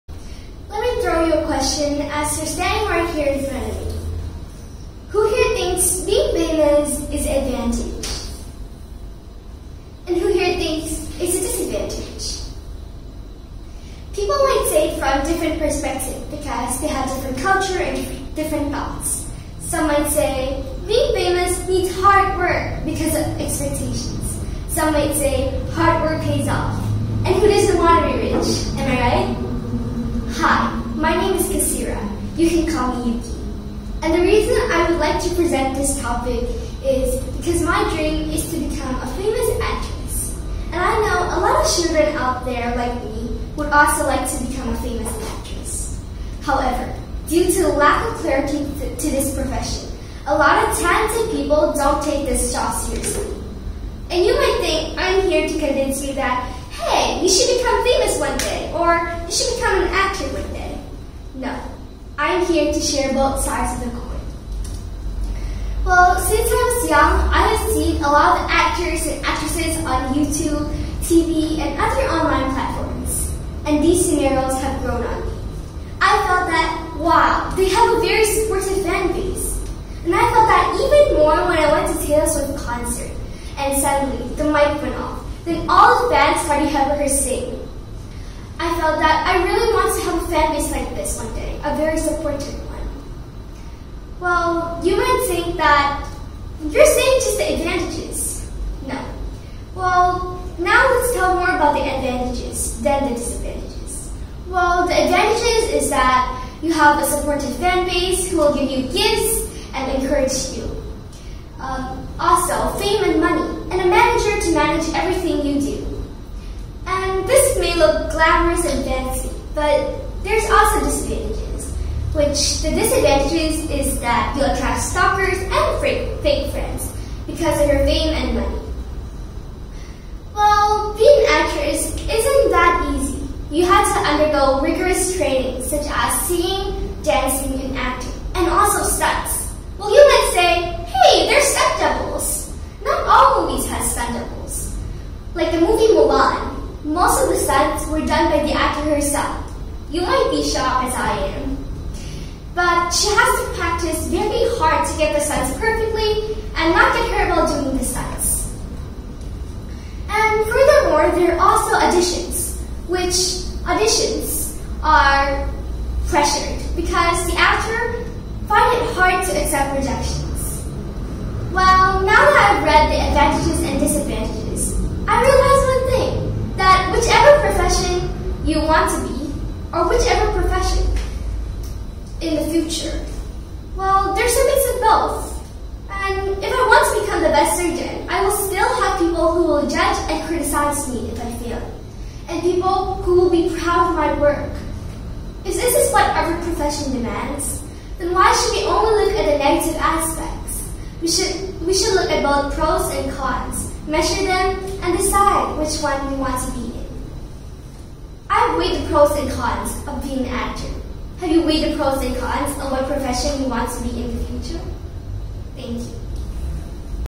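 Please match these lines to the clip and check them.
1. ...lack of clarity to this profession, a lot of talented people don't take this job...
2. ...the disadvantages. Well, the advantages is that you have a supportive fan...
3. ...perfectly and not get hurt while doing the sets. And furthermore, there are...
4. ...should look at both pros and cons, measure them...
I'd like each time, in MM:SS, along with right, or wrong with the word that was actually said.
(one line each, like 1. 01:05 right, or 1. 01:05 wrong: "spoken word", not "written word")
1. 00:47 right
2. 01:43 right
3. 02:35 right
4. 03:21 right.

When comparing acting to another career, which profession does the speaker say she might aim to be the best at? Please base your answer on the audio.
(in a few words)
Surgeon.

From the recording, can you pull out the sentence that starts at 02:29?
You might be shocked as I am.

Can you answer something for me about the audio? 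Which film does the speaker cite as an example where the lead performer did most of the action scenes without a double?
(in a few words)
Mulan.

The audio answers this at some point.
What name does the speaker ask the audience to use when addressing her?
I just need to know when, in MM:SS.
00:33.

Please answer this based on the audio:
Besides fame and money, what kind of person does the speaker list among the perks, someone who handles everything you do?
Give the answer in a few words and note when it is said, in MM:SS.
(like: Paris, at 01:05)
A manager, at 01:53.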